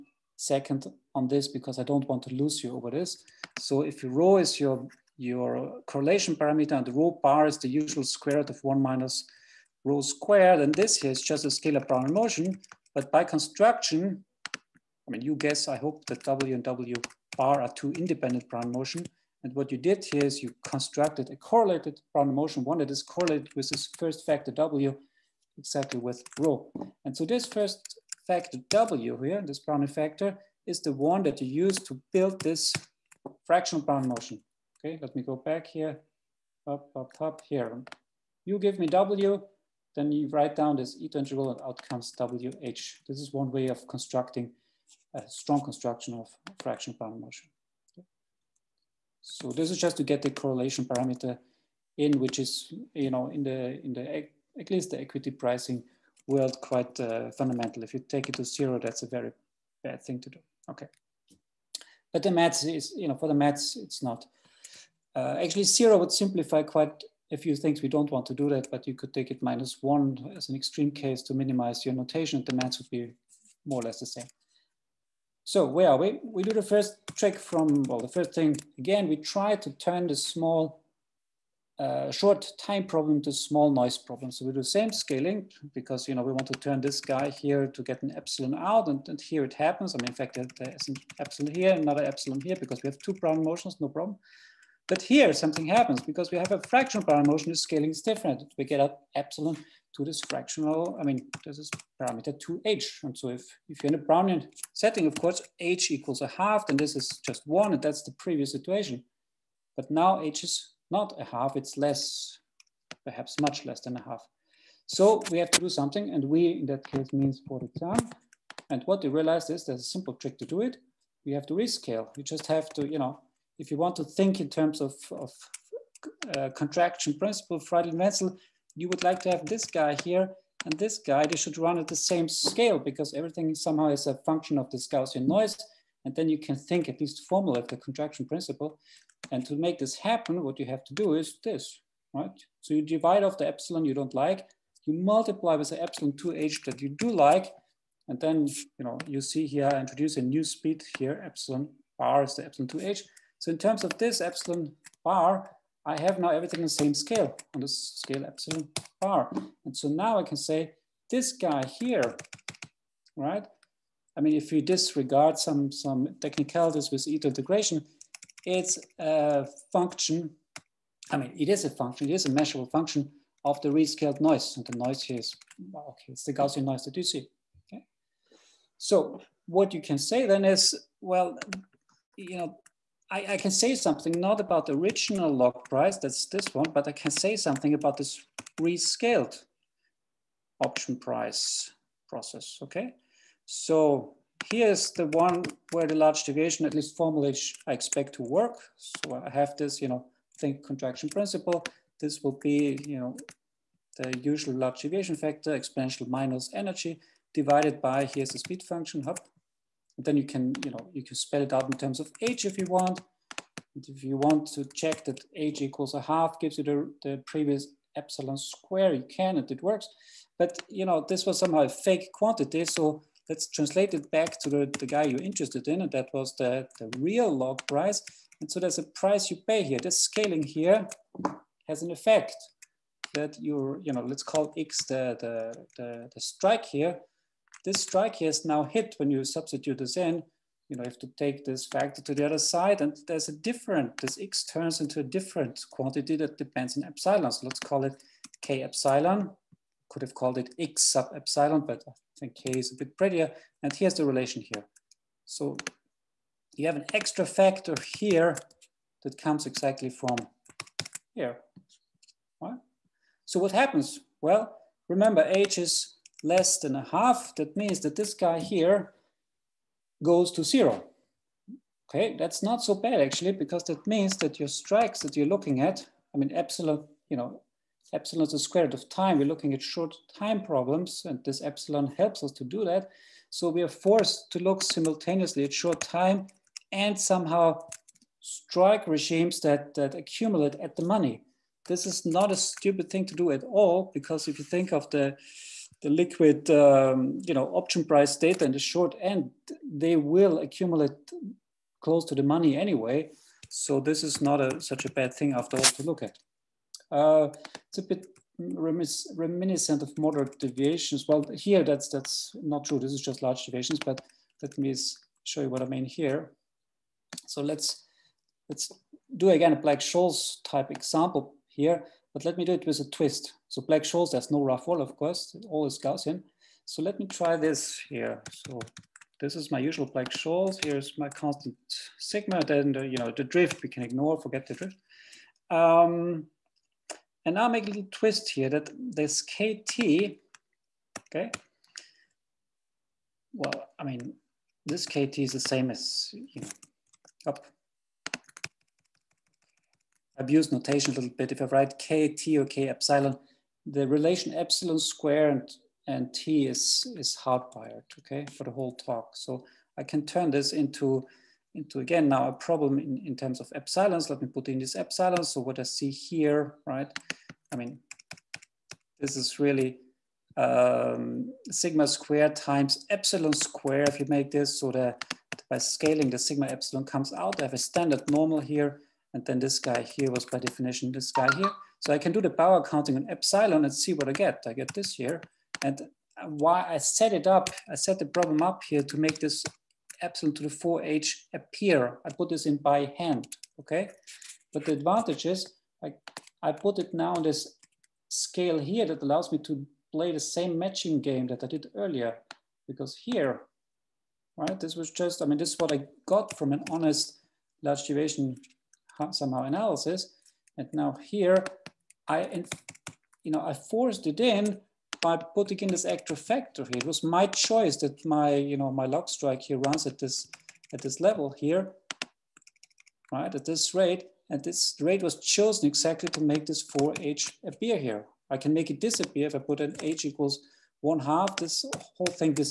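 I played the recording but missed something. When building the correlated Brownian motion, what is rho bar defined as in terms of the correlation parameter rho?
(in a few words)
square root of 1 minus rho squared.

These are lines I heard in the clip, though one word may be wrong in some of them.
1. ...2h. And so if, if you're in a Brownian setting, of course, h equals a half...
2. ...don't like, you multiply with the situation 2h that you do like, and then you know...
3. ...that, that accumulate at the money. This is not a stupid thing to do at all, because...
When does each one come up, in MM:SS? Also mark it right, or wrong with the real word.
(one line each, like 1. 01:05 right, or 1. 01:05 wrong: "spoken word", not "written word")
1. 01:42 right
2. 02:23 wrong: "epsilon", not "situation"
3. 04:49 right.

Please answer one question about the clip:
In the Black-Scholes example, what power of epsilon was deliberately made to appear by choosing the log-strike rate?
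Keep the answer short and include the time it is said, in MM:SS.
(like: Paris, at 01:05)
epsilon to the 4h, at 06:30.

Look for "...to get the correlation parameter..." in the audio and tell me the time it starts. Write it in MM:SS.
00:49.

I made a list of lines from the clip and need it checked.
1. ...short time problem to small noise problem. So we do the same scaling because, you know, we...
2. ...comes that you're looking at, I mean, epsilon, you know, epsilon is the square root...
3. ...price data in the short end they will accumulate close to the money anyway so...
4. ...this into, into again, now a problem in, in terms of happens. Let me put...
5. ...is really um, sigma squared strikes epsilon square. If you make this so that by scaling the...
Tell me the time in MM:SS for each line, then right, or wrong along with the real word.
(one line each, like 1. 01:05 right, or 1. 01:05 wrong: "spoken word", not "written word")
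1. 01:22 right
2. 04:34 wrong: "strikes", not "comes"
3. 04:57 right
4. 06:00 wrong: "epsilons", not "happens"
5. 06:09 wrong: "times", not "strikes".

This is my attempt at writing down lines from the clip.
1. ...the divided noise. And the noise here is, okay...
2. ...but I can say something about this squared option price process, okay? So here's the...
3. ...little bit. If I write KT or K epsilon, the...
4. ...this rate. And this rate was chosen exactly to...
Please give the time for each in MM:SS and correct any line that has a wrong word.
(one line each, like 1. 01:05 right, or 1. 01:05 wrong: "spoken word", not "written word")
1. 02:53 wrong: "rescaled", not "divided"
2. 03:06 wrong: "rescaled", not "squared"
3. 05:50 right
4. 07:03 right.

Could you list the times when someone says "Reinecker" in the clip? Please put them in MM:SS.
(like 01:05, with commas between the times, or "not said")
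not said.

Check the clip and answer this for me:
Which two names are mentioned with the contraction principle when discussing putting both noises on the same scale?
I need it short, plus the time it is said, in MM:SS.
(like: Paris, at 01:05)
Freidlin Wentzell, at 02:07.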